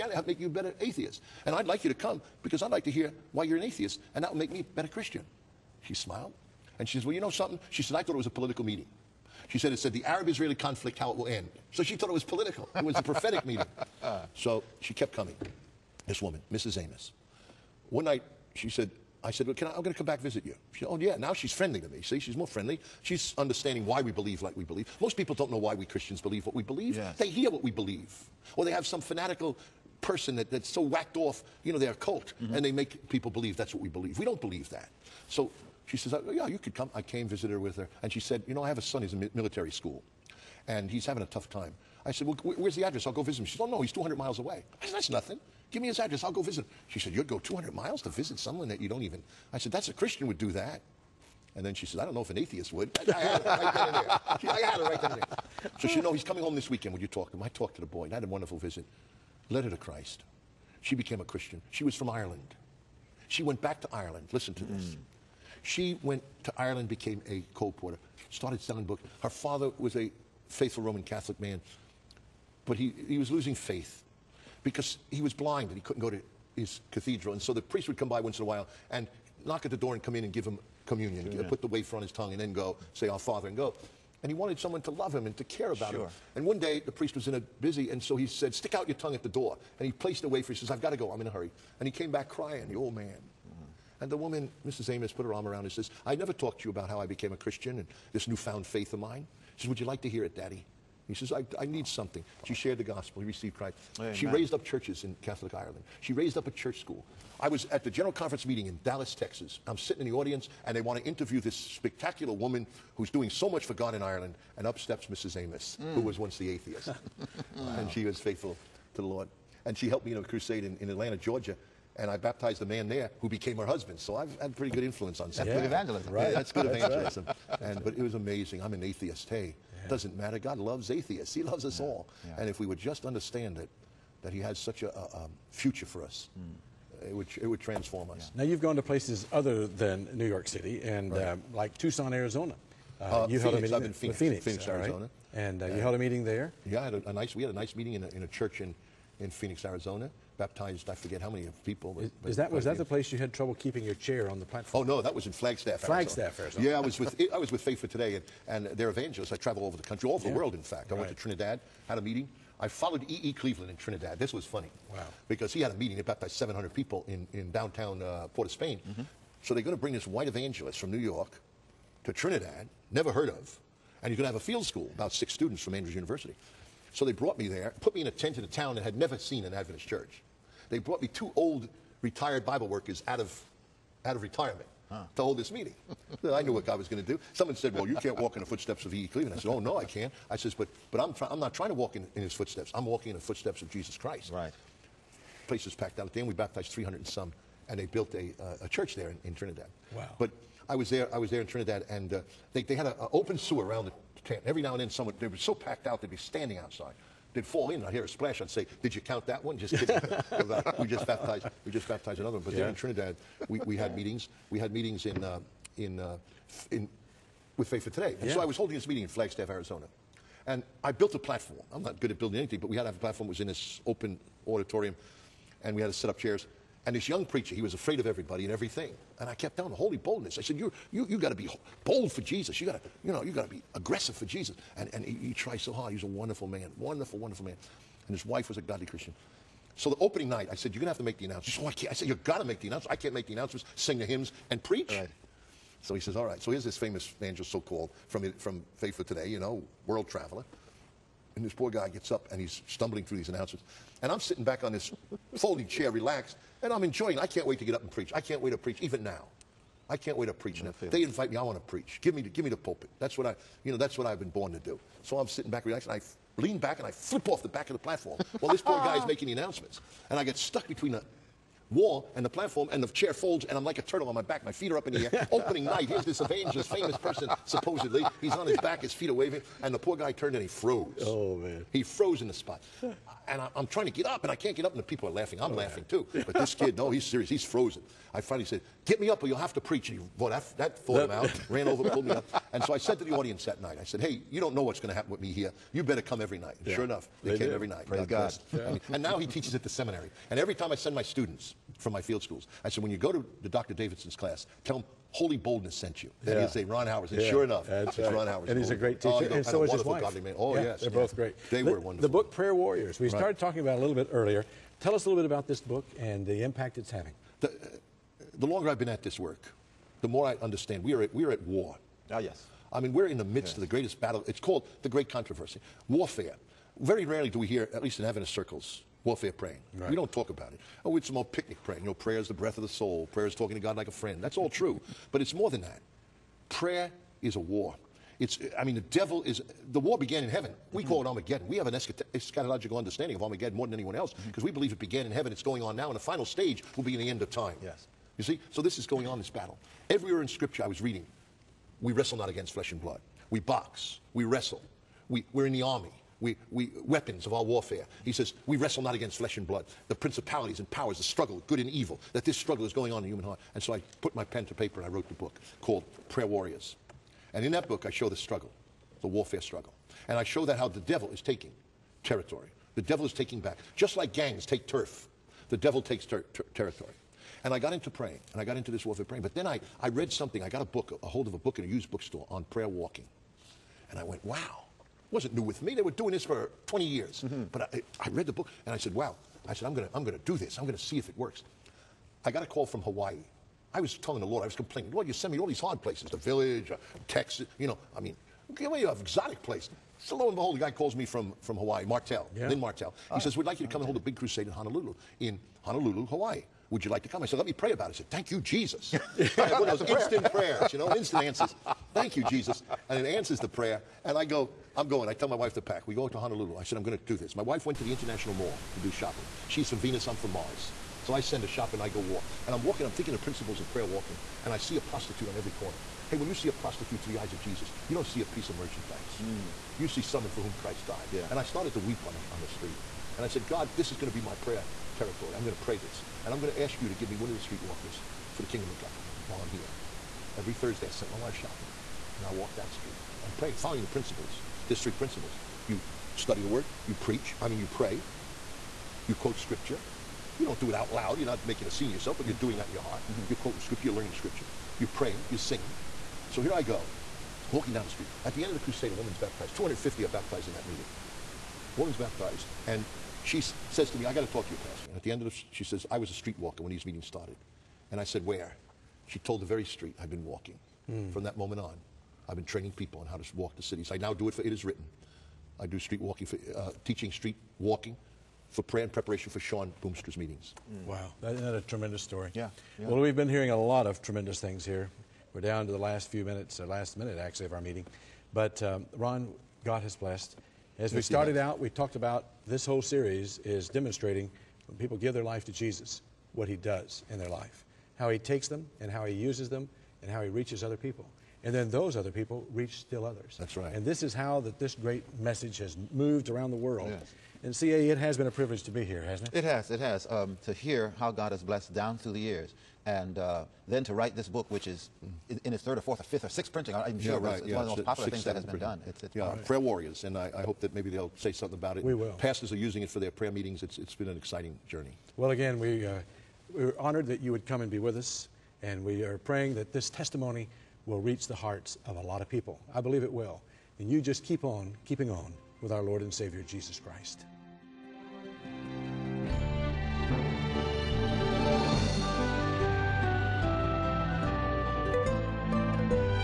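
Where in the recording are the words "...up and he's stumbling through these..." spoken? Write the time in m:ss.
4:12.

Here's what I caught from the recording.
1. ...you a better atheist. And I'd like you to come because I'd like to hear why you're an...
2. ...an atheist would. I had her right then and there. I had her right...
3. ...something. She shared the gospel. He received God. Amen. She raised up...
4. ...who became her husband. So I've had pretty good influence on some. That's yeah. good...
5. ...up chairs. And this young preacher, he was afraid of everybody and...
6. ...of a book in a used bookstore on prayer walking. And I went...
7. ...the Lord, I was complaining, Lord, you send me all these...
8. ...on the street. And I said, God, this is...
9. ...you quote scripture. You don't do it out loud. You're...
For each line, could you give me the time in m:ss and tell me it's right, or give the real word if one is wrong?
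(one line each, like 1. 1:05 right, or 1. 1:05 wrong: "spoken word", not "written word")
1. 0:00 right
2. 0:52 right
3. 1:41 wrong: "Christ", not "God"
4. 2:03 right
5. 3:46 right
6. 6:21 right
7. 6:34 right
8. 7:12 right
9. 7:29 right.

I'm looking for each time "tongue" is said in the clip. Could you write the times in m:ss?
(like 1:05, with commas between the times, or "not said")
1:22, 1:28.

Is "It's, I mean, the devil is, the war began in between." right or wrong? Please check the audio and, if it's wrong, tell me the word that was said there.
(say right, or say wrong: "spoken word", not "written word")
wrong: "heaven", not "between".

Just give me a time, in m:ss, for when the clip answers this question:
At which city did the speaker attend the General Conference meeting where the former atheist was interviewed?
1:48.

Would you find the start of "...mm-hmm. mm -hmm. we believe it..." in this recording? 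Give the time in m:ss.
5:44.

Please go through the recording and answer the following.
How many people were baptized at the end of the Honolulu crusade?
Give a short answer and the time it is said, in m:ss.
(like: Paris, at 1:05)
250, at 7:39.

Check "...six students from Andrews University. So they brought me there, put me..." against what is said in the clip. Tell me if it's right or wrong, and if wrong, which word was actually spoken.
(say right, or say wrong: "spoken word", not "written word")
right.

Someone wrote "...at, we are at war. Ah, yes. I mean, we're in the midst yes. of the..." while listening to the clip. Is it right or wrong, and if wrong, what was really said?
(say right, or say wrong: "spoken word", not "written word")
right.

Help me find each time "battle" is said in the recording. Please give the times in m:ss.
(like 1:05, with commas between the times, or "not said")
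5:23, 5:49.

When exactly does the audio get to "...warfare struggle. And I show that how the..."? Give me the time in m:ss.
6:09.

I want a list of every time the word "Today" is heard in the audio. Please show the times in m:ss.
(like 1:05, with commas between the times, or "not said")
2:37, 3:37, 4:09.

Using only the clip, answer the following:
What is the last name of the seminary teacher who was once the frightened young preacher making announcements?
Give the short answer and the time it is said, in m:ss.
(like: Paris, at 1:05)
Davidson, at 5:03.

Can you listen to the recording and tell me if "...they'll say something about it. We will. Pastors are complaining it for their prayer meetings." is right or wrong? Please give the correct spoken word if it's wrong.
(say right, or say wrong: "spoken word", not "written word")
wrong: "using", not "complaining".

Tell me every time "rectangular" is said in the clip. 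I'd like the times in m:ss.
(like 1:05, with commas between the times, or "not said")
not said.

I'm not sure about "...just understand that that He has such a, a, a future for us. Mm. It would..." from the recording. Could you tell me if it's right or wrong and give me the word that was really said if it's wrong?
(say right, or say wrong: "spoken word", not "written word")
right.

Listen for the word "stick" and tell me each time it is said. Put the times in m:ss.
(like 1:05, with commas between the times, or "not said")
1:28.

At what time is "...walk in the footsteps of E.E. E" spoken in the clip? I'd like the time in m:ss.
3:08.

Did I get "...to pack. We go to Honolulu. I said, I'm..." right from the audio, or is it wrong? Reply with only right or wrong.
right.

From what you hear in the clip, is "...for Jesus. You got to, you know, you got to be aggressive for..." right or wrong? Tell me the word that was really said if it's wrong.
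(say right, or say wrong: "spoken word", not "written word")
right.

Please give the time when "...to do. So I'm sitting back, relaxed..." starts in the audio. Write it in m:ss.
4:24.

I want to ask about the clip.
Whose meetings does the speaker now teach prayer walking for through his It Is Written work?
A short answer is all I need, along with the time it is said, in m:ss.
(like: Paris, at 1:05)
Shawn Boonstra, at 7:59.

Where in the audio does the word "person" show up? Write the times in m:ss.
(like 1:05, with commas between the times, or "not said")
0:30, 4:36.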